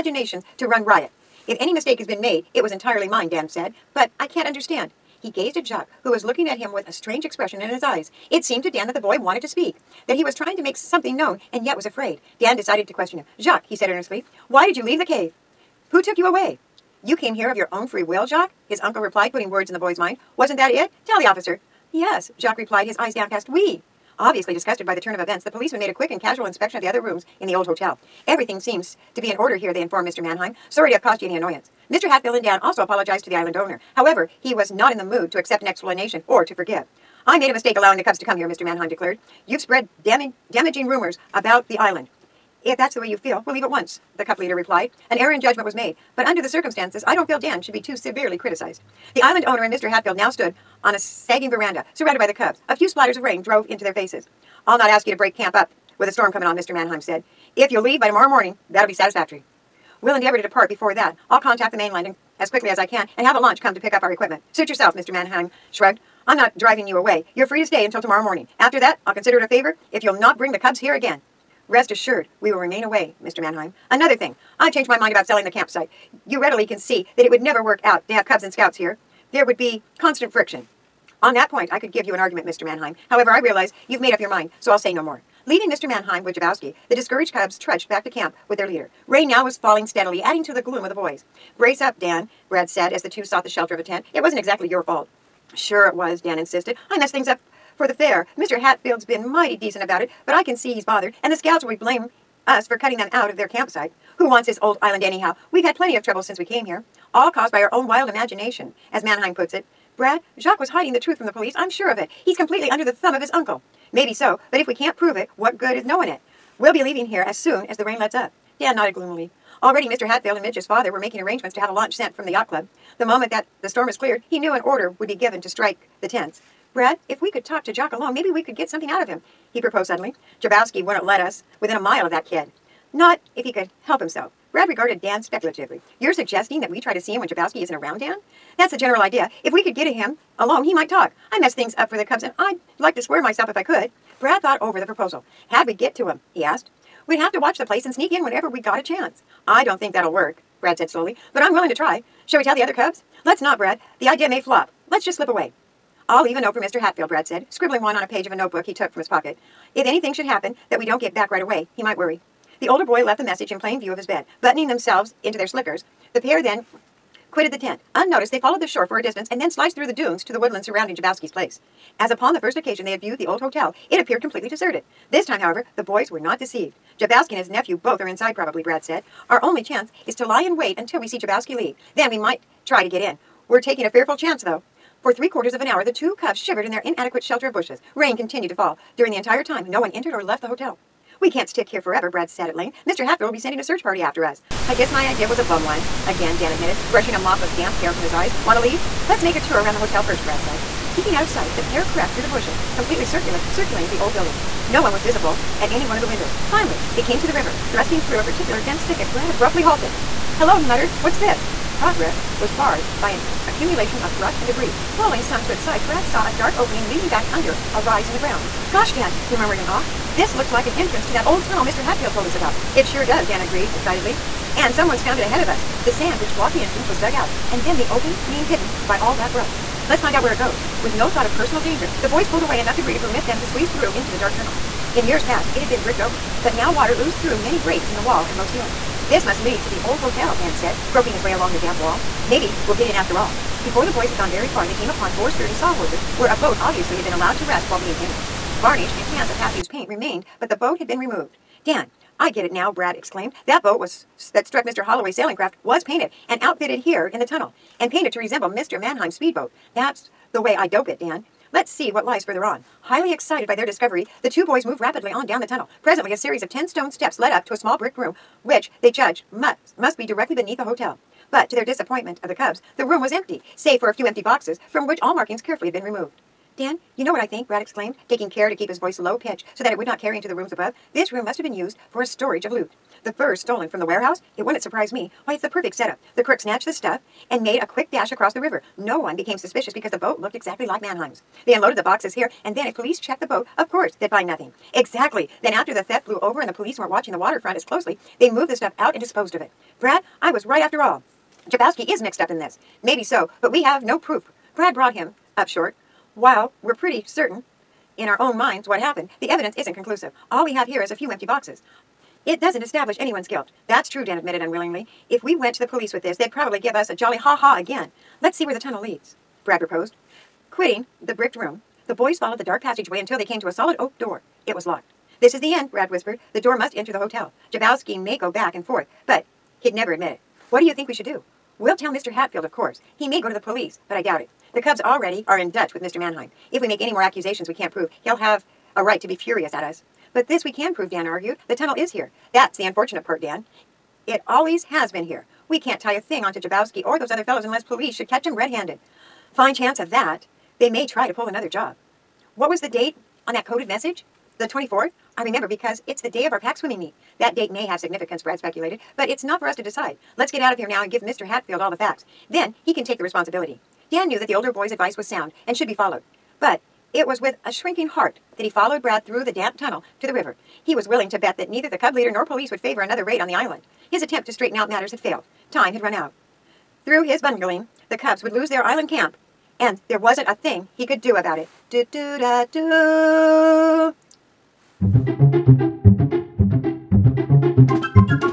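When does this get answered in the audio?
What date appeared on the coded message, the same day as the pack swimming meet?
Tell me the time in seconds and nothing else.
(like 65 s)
354 s.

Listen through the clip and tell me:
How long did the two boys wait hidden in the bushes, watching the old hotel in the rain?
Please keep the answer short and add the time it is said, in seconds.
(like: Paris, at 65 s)
Three quarters of an hour, at 185 s.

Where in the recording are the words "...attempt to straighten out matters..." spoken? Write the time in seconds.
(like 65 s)
374 s.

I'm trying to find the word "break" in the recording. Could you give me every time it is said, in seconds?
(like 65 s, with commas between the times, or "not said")
55 s, 237 s.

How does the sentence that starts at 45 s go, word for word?
An error in judgment was made, but under the circumstances, I don't feel Dan should be too severely criticized.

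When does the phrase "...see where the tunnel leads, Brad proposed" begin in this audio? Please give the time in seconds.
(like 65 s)
318 s.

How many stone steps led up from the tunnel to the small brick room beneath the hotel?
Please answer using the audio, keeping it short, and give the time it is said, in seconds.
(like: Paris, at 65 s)
10, at 266 s.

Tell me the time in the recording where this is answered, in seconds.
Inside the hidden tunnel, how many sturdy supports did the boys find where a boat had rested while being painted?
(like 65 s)
245 s.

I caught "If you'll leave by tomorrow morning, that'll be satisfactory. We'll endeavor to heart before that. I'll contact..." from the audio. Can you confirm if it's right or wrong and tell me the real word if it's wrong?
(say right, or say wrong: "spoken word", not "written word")
wrong: "depart", not "heart".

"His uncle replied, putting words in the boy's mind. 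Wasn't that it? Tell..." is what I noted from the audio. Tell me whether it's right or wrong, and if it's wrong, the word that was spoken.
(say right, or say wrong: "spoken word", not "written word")
right.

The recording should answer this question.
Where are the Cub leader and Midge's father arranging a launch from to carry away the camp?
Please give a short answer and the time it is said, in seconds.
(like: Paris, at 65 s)
The yacht club, at 122 s.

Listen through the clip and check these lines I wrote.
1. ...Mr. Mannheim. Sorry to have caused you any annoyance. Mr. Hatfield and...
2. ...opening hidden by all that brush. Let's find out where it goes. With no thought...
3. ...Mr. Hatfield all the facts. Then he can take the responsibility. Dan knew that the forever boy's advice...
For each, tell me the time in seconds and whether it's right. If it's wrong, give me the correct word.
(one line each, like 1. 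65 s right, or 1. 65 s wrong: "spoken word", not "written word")
1. 30 s right
2. 227 s right
3. 361 s wrong: "older", not "forever".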